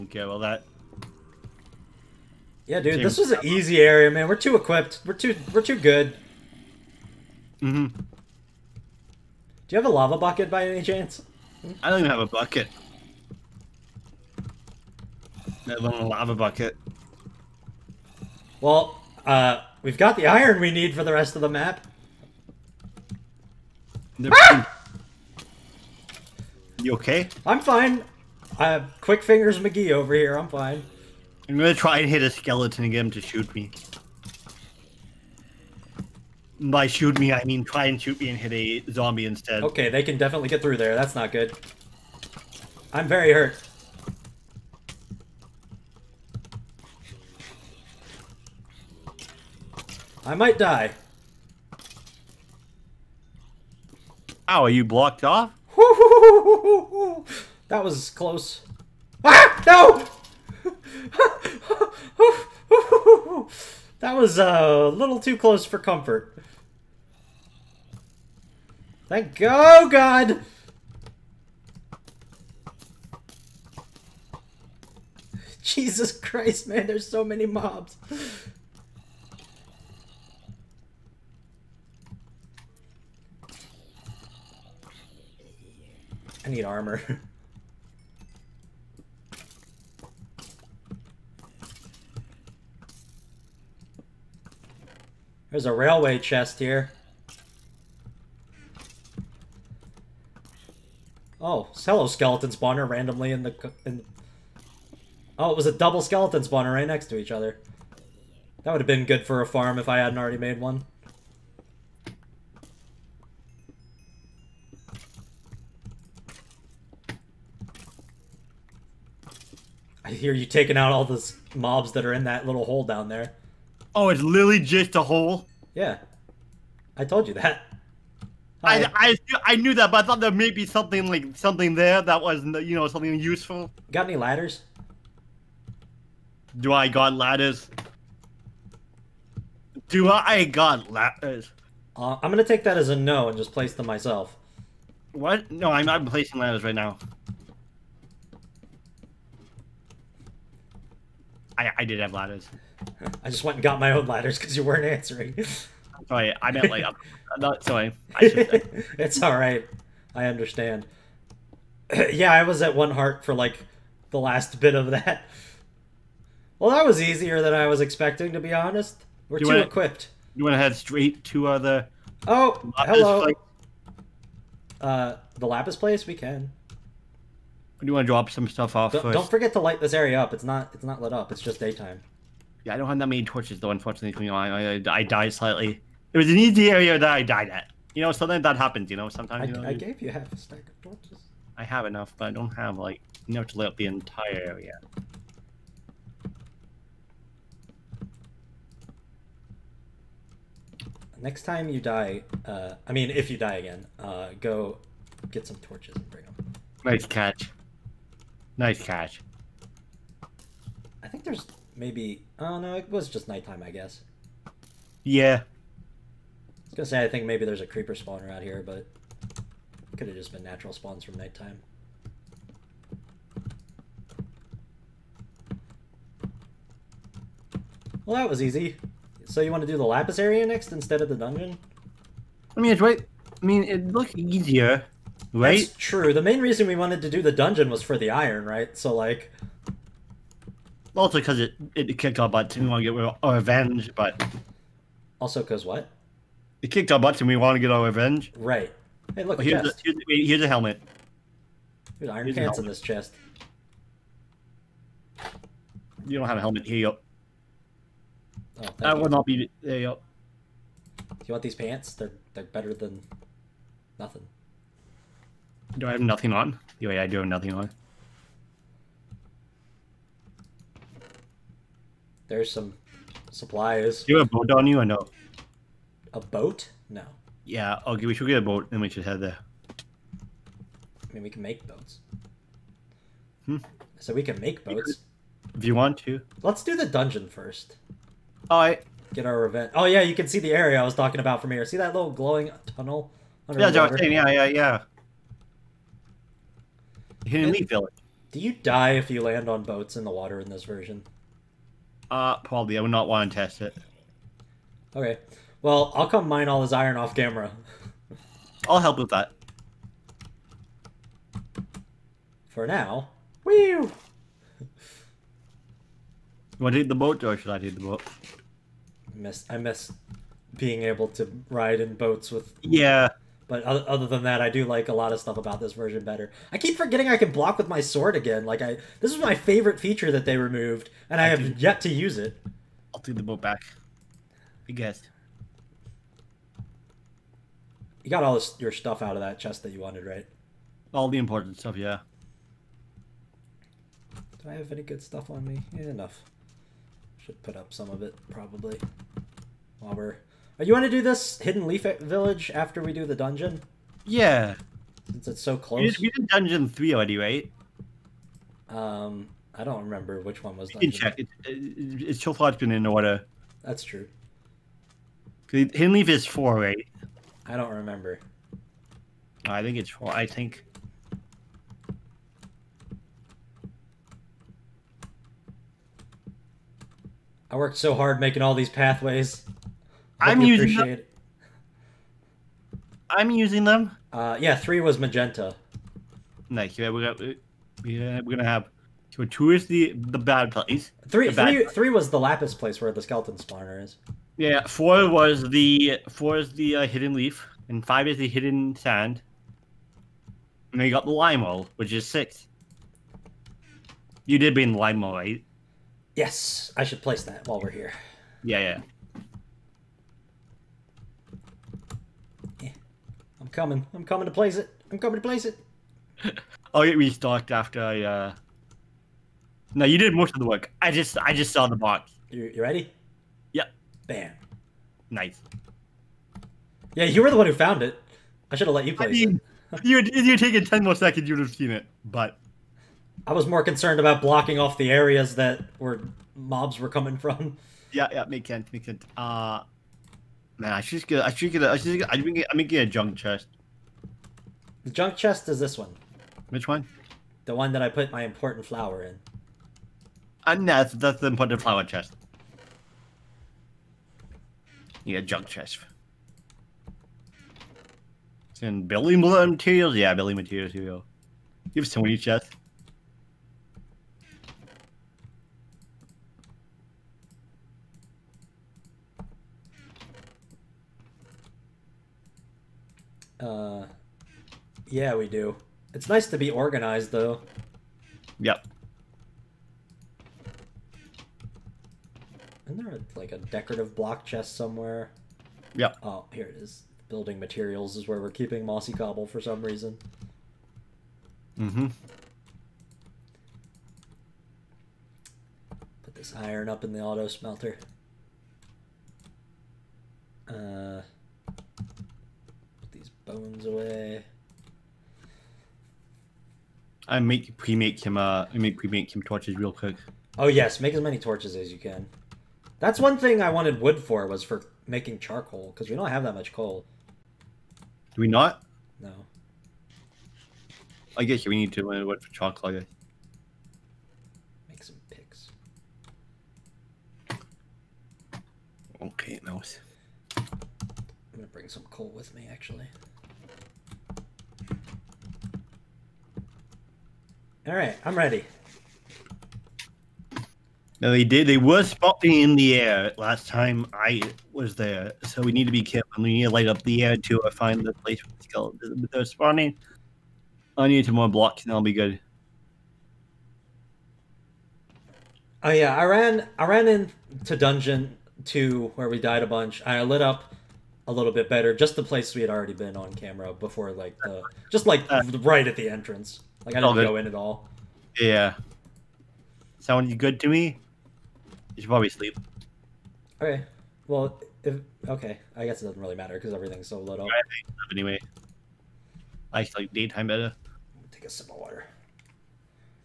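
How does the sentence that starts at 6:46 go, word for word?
Yes, I should place that while we're here.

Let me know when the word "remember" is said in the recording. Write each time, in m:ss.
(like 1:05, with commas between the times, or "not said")
5:59, 6:07.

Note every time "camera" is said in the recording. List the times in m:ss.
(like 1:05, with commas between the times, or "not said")
5:07, 9:23.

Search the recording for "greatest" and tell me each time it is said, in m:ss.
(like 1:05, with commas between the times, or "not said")
not said.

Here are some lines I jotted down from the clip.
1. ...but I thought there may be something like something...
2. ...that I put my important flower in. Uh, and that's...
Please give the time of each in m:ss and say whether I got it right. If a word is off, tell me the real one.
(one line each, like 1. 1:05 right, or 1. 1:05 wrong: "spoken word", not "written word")
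1. 2:09 right
2. 7:27 right.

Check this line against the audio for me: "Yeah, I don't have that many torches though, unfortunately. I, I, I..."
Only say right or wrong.
right.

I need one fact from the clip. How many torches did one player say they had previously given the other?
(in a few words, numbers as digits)
Half a stack.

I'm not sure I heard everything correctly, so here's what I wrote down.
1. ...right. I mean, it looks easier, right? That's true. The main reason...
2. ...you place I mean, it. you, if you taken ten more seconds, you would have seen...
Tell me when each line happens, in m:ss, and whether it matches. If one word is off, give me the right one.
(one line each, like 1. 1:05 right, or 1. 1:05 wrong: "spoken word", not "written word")
1. 3:52 right
2. 7:08 right.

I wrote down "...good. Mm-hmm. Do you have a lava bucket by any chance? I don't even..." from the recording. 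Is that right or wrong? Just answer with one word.
right.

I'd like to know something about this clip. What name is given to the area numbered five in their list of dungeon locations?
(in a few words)
Hidden sand.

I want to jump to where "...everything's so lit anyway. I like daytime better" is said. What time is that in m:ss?
9:36.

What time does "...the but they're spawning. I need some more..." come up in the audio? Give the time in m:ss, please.
9:08.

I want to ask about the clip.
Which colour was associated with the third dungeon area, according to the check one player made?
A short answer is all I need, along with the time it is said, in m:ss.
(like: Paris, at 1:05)
Magenta, at 6:24.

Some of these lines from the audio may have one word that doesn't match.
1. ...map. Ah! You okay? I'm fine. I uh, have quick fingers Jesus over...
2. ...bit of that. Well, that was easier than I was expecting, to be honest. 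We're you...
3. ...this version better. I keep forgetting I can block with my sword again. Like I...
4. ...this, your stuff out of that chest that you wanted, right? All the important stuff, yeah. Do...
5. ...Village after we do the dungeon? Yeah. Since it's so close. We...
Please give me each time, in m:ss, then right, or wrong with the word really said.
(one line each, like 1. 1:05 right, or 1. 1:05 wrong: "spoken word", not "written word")
1. 0:21 wrong: "McGee", not "Jesus"
2. 2:44 right
3. 5:25 right
4. 5:38 right
5. 5:52 right.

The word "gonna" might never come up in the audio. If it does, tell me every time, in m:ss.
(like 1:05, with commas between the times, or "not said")
0:31, 2:22, 3:36, 6:28, 8:51.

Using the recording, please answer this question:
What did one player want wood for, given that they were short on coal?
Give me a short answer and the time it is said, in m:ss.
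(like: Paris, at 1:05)
Making charcoal, at 8:34.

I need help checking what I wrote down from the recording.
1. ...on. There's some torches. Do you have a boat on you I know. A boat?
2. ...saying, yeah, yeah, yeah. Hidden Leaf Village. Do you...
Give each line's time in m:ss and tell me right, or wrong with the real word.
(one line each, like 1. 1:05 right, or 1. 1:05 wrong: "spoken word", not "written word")
1. 4:27 wrong: "supplies", not "torches"
2. 4:53 right.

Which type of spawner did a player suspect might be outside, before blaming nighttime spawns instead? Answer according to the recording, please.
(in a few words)
Creeper spawner.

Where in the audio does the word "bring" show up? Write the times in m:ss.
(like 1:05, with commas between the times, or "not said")
3:26, 8:51.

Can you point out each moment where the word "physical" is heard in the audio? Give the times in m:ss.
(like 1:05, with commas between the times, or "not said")
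not said.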